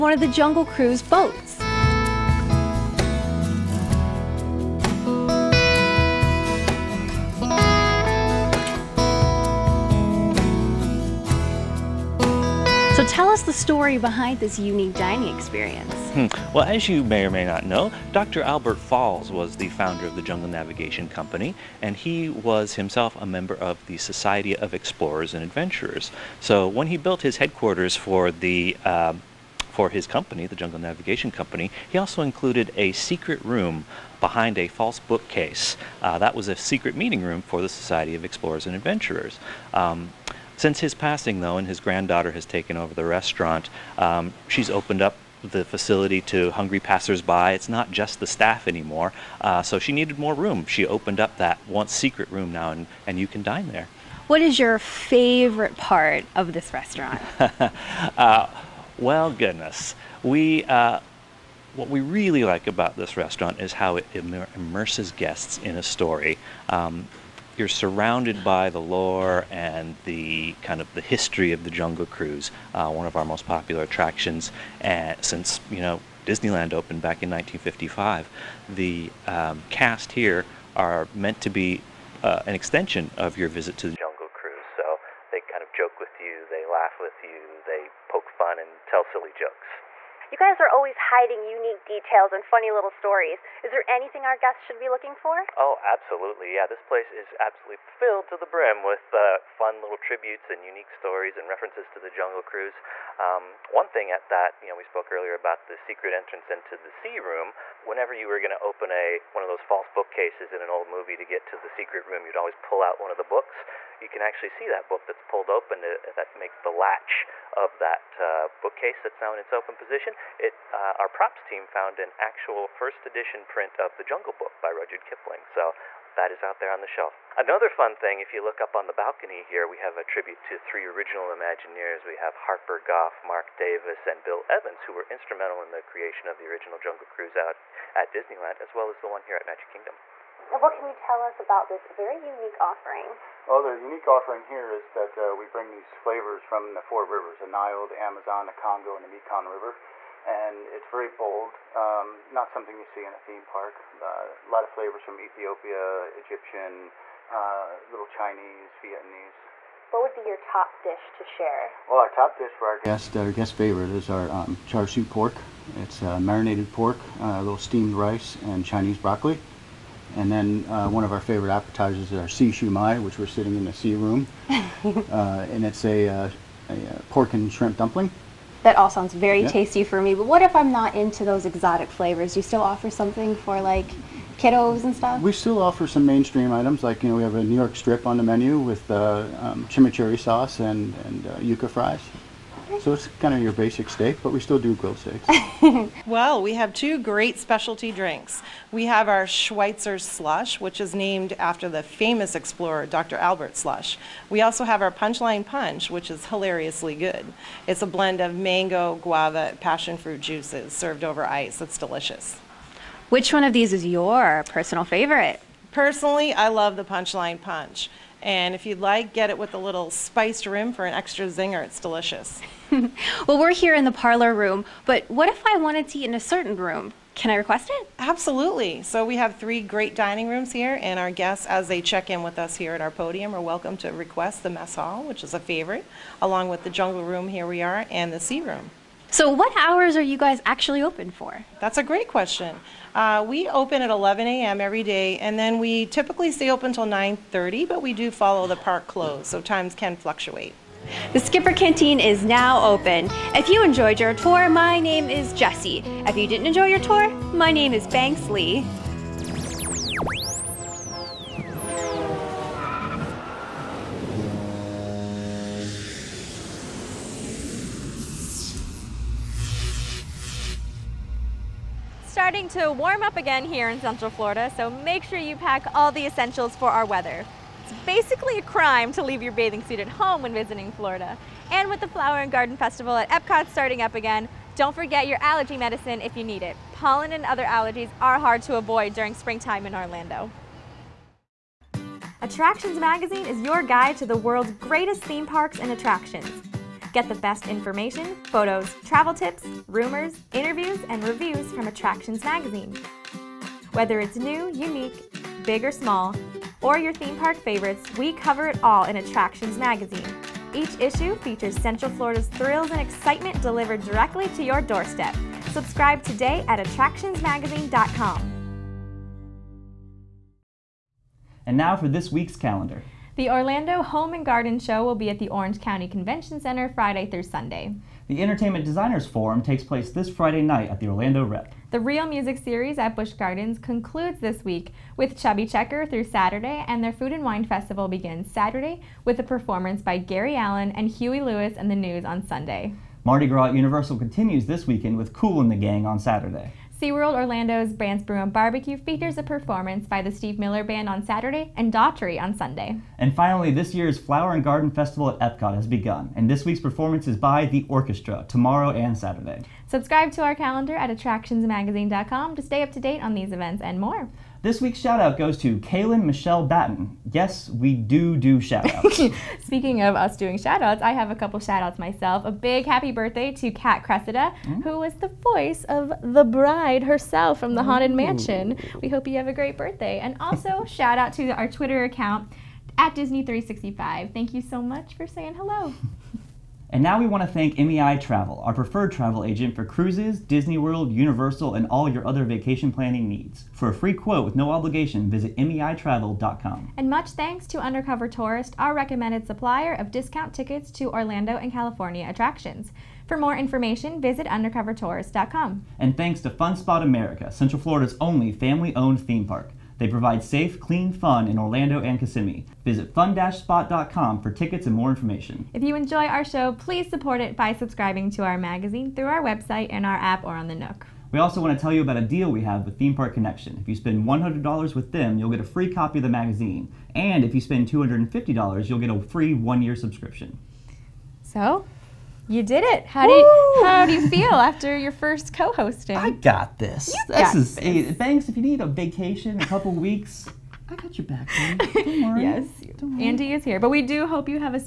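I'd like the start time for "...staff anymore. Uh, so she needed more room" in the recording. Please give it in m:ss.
0:48.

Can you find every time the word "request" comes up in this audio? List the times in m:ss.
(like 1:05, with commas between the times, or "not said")
3:47, 3:53.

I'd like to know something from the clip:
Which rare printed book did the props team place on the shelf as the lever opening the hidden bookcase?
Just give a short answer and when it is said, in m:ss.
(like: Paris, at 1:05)
The Jungle Book, at 2:03.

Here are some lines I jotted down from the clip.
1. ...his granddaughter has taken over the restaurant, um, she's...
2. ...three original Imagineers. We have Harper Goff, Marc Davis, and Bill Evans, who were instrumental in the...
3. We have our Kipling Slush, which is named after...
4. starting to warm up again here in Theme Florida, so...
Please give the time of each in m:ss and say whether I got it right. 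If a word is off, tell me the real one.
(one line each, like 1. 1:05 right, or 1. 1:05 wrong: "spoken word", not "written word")
1. 0:41 right
2. 2:10 right
3. 3:18 wrong: "Schweitzer", not "Kipling"
4. 4:32 wrong: "Central", not "Theme".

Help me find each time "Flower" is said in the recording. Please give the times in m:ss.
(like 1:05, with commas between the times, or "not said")
4:41, 5:53.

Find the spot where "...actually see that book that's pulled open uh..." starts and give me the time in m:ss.
1:54.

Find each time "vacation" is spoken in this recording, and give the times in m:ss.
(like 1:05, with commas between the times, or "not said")
6:32, 7:18.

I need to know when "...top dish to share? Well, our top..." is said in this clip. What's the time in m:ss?
2:40.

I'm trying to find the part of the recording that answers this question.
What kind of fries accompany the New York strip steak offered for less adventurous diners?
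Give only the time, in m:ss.
3:11.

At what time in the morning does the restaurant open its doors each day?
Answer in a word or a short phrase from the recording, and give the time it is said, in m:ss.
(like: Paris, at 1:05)
11 a.m., at 4:03.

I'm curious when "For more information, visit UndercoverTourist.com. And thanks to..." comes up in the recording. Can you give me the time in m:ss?
6:43.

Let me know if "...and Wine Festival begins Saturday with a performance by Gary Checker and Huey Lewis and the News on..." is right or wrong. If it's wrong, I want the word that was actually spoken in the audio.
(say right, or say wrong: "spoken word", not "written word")
wrong: "Allan", not "Checker".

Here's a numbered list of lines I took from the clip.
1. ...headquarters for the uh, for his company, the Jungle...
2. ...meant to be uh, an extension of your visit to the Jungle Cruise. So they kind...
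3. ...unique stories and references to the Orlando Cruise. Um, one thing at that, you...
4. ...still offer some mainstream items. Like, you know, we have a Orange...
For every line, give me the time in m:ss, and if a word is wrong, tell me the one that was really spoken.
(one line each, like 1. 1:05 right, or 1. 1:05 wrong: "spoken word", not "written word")
1. 0:27 right
2. 1:21 right
3. 1:40 wrong: "Jungle", not "Orlando"
4. 3:05 wrong: "New", not "Orange".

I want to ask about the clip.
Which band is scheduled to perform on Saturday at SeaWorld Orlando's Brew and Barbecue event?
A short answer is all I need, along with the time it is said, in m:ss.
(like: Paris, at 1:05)
Steve Miller Band, at 5:50.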